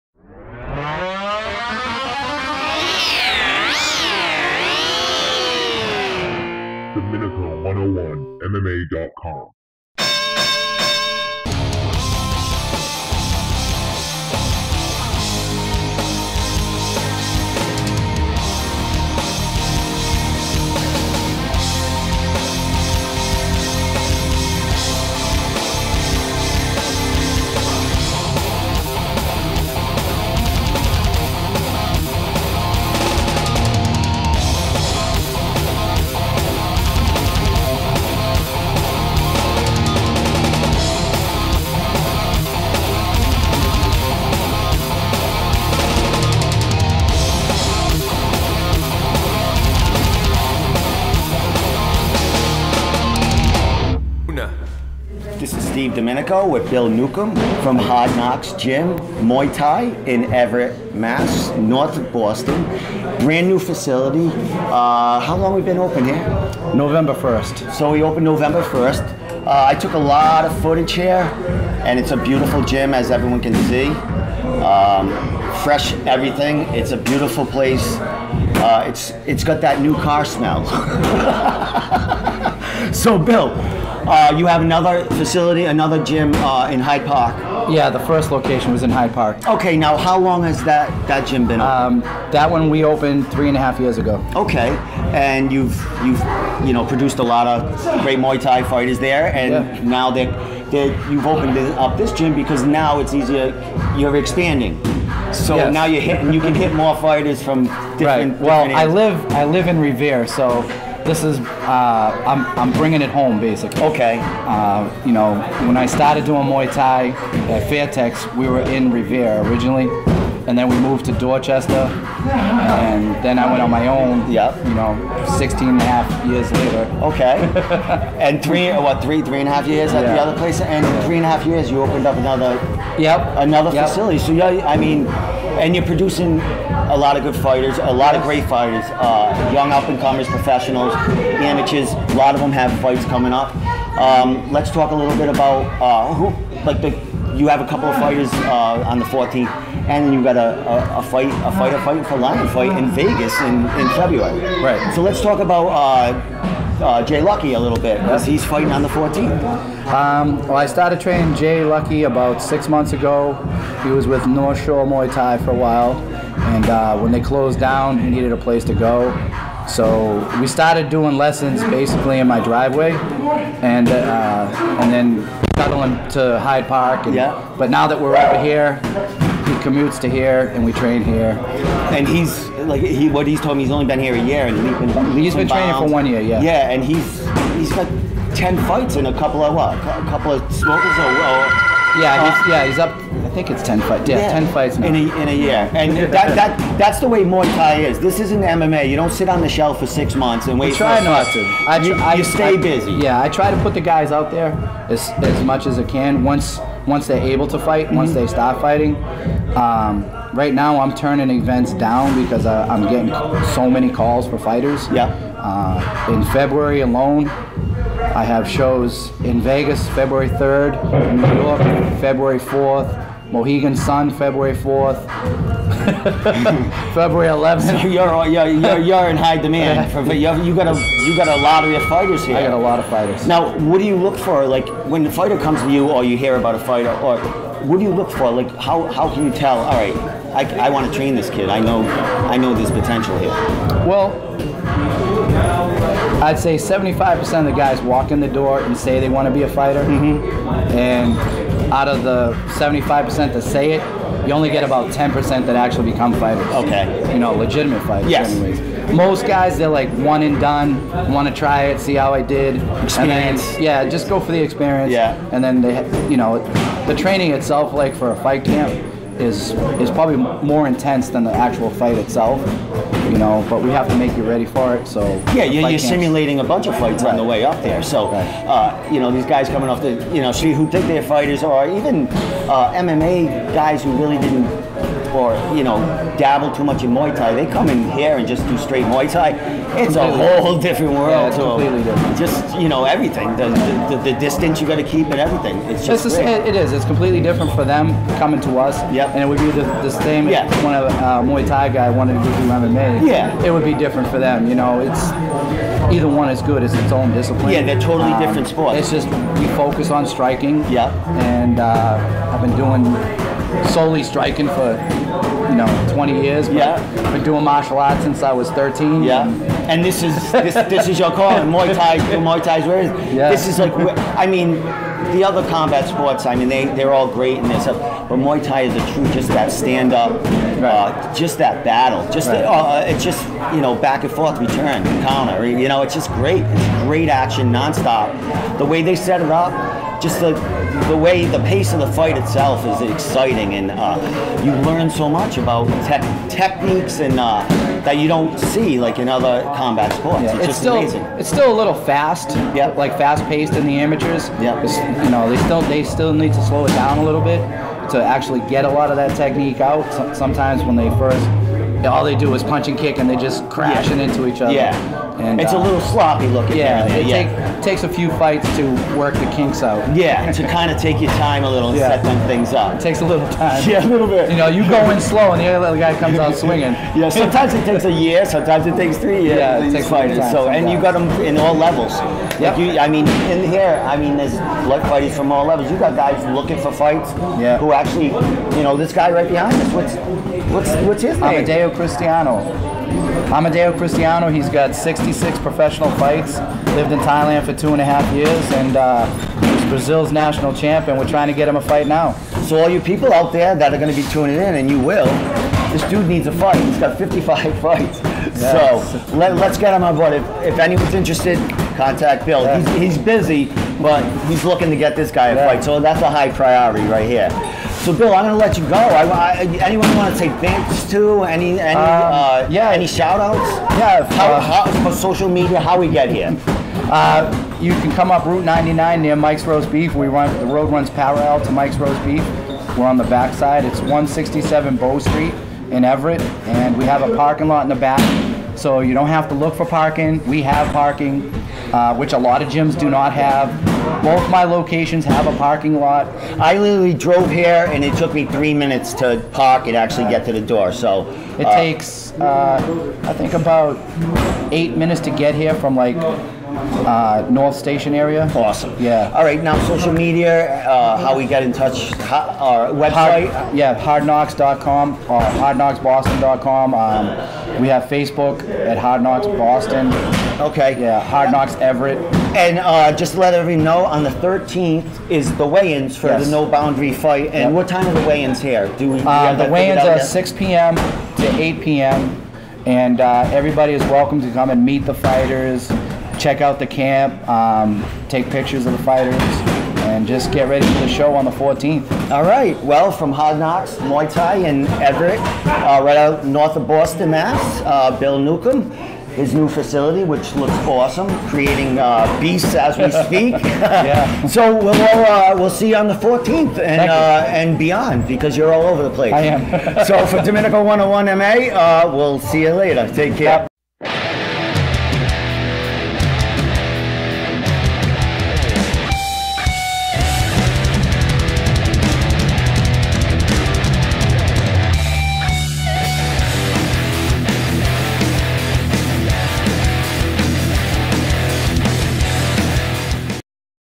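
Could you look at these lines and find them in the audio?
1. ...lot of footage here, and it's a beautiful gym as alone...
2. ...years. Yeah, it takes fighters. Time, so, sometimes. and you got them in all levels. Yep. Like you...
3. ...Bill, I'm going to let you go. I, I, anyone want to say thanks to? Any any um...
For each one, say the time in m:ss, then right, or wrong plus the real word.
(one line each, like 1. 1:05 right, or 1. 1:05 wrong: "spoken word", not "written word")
1. 1:09 wrong: "everyone", not "alone"
2. 6:19 right
3. 6:57 right.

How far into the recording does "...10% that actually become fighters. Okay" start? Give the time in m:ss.
4:14.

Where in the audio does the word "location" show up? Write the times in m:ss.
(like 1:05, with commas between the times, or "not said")
1:28, 7:24.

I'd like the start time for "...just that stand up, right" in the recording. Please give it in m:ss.
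5:29.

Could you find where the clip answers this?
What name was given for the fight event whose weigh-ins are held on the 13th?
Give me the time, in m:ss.
7:56.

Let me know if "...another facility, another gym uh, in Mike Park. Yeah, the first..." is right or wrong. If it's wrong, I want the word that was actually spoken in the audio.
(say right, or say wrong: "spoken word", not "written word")
wrong: "Hyde", not "Mike".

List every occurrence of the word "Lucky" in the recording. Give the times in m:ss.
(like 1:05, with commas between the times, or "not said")
2:37, 2:41.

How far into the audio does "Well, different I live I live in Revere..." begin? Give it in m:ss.
1:48.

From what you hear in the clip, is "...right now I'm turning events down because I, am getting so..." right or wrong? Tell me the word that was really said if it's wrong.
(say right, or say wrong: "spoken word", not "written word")
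right.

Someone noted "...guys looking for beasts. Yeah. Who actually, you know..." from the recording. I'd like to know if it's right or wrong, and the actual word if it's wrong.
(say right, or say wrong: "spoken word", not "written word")
wrong: "fights", not "beasts".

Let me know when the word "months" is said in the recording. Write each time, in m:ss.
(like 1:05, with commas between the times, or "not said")
2:42, 3:20.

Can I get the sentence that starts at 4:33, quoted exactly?
You know, but we have to make you ready for it.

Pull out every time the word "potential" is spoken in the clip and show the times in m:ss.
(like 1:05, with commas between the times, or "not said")
4:02.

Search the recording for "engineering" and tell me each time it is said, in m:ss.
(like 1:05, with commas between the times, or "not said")
not said.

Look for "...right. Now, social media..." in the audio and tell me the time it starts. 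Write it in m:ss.
7:39.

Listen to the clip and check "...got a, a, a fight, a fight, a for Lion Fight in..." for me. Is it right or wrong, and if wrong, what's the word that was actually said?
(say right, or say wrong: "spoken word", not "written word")
right.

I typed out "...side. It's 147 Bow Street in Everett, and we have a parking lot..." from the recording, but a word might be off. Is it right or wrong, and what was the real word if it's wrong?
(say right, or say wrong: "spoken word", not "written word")
wrong: "167", not "147".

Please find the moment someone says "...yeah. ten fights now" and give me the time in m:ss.
3:14.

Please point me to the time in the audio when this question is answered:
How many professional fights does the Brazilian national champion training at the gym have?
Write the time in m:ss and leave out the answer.
6:34.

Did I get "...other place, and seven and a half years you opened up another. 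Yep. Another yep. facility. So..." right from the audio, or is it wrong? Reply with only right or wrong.
wrong.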